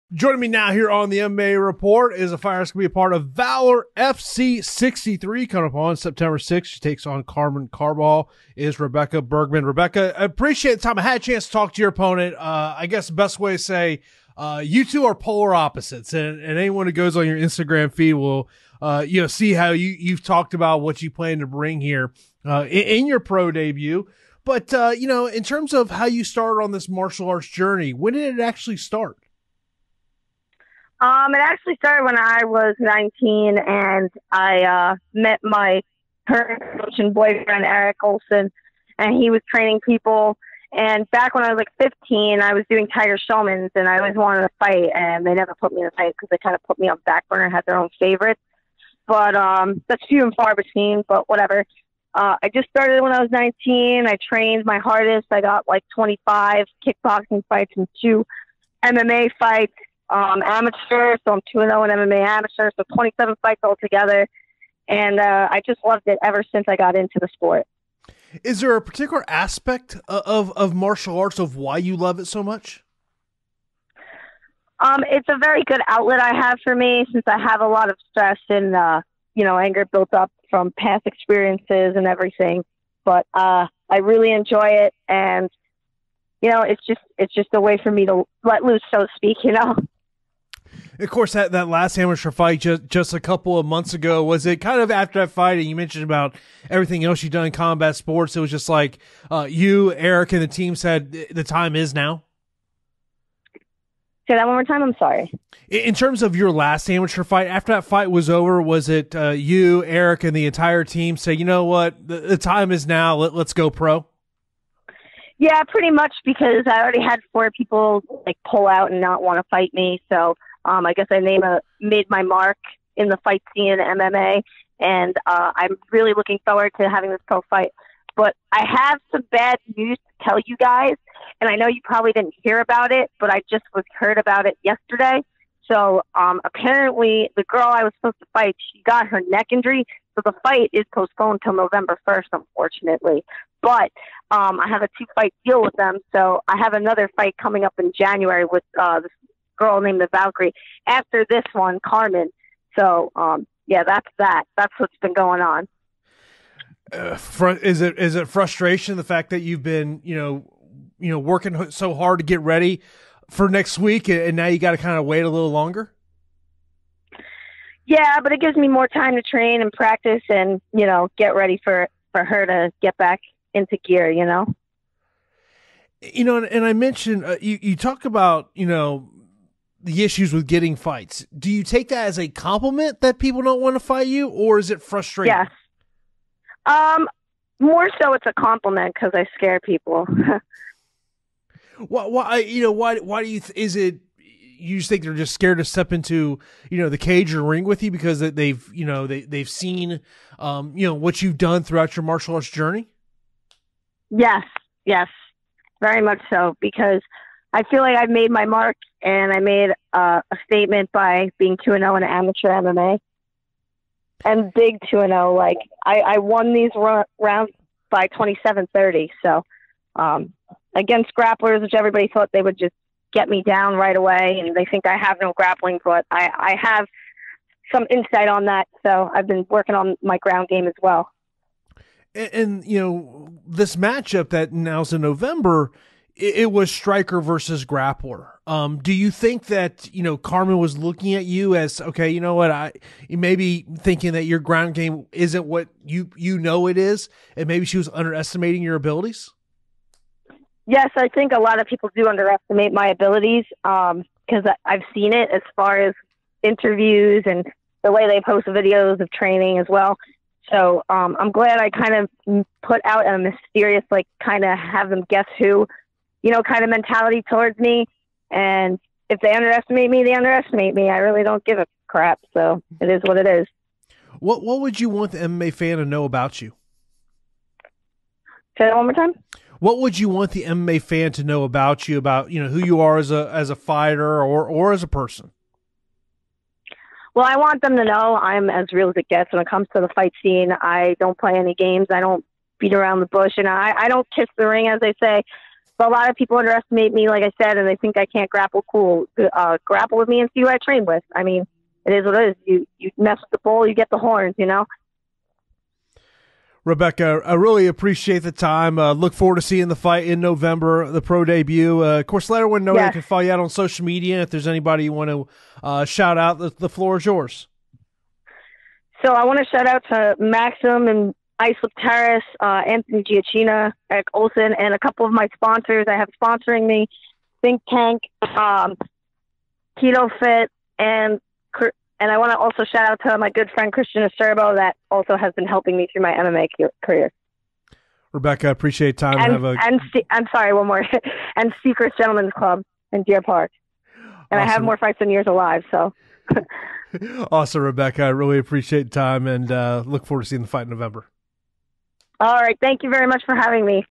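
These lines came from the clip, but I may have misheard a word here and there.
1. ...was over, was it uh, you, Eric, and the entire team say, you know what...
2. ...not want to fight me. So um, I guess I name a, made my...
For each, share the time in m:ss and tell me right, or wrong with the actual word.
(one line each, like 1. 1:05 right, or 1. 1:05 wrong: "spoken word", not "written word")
1. 1:48 right
2. 1:59 right.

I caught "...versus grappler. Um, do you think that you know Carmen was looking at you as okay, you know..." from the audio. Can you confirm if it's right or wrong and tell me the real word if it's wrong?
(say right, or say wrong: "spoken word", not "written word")
right.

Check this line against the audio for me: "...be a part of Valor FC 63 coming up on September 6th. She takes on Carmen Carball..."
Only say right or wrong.
right.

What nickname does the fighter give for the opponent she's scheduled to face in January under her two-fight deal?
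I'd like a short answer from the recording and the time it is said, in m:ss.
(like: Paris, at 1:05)
the Valkyrie, at 2:30.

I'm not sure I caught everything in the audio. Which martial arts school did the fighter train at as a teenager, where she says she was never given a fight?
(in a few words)
Tiger Schulmann's.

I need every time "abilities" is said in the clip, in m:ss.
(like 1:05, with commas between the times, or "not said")
4:08, 4:12.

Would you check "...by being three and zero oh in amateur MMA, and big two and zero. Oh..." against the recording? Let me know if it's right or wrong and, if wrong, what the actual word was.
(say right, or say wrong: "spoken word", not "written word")
wrong: "two", not "three".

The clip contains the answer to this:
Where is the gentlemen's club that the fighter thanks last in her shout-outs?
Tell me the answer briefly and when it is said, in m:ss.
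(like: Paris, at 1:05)
Deer Park, at 5:43.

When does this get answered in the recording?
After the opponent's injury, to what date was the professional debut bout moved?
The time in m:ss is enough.
2:21.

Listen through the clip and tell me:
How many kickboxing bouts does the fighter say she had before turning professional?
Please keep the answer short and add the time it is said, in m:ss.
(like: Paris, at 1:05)
25, at 0:55.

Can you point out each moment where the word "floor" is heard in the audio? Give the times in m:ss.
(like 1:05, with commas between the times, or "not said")
5:16.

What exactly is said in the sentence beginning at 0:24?
But, uh, you know, in terms of how you started on this martial arts journey, when did it actually start?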